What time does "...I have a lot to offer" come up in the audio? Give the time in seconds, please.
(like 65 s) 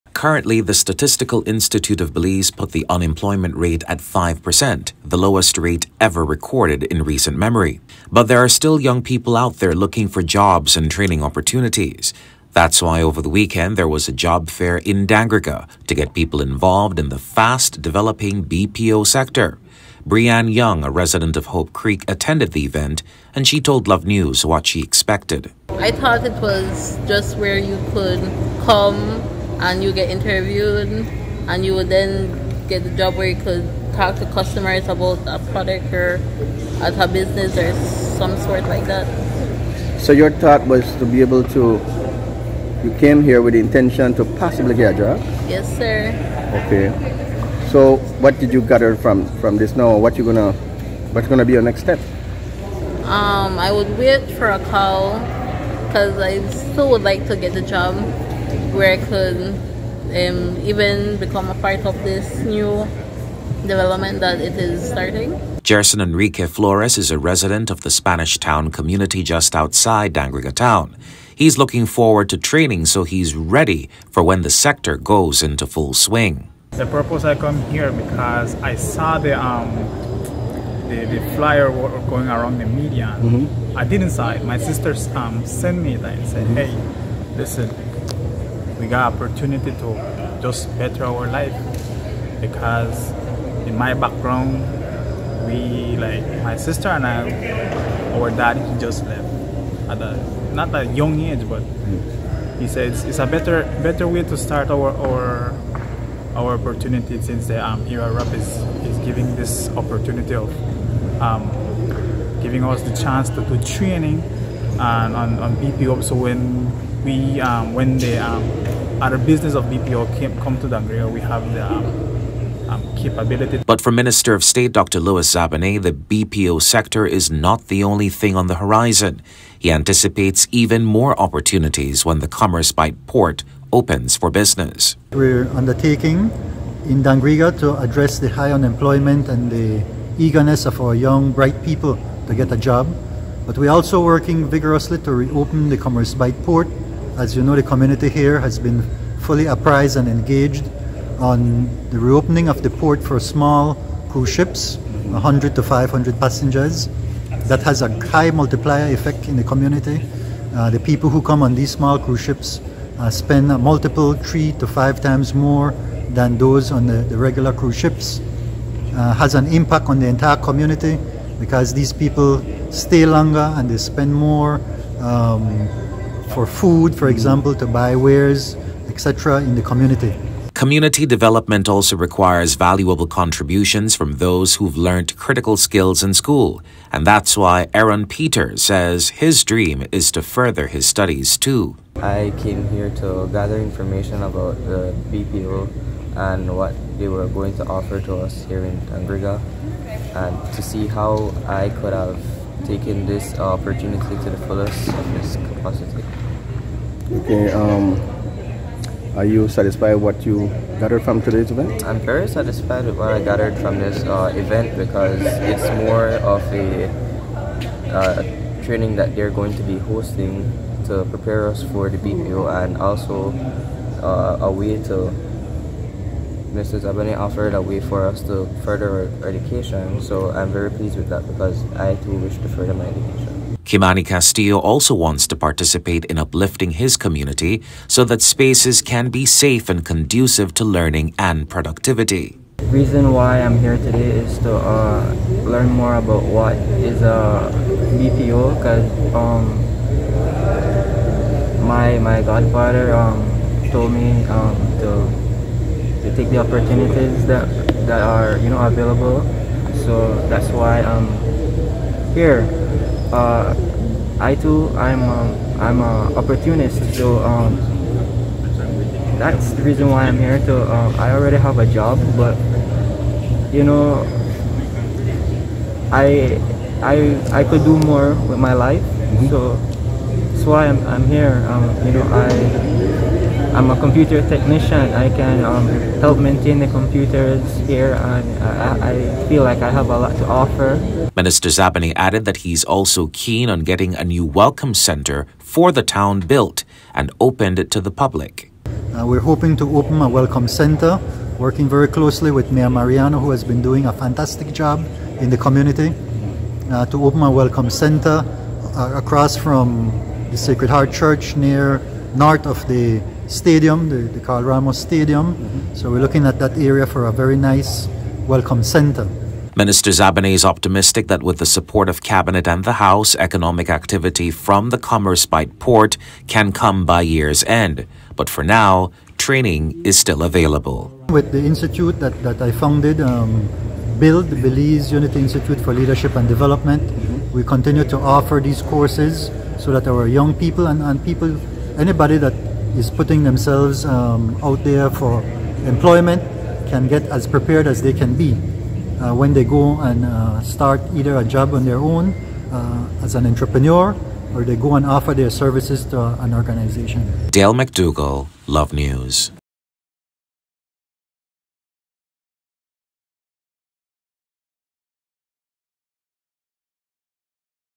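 289 s.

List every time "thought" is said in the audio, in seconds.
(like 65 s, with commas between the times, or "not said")
25 s, 40 s.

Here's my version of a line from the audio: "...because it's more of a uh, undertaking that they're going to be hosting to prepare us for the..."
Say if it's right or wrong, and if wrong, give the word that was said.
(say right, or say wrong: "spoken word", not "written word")
wrong: "training", not "undertaking".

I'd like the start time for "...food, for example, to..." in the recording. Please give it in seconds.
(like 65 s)
176 s.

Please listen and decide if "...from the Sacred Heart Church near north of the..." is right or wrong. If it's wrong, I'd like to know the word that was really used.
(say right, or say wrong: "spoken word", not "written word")
right.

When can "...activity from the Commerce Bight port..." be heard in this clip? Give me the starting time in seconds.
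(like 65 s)
323 s.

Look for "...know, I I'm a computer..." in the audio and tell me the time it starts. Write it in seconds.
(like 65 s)
281 s.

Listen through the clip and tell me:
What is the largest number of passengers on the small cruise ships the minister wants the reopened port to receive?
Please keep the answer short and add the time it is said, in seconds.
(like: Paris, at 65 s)
500, at 155 s.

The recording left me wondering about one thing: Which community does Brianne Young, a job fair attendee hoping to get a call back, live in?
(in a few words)
Hope Creek.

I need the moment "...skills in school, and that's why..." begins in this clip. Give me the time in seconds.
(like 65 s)
185 s.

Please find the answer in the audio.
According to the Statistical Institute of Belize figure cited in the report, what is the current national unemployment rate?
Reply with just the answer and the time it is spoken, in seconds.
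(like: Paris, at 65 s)
5%, at 4 s.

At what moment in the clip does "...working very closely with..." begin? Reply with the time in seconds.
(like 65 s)
301 s.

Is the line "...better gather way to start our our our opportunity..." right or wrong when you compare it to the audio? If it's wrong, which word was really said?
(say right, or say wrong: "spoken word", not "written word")
wrong: "better", not "gather".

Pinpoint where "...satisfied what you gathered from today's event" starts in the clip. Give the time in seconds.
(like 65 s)
209 s.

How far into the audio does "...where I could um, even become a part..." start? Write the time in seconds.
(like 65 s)
58 s.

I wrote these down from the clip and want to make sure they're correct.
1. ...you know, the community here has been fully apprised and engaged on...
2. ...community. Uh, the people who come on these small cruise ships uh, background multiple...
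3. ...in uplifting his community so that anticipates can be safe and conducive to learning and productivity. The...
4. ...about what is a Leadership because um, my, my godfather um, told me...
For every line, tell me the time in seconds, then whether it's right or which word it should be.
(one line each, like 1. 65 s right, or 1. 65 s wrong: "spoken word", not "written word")
1. 147 s right
2. 159 s wrong: "spend", not "background"
3. 236 s wrong: "spaces", not "anticipates"
4. 245 s wrong: "BPO", not "Leadership".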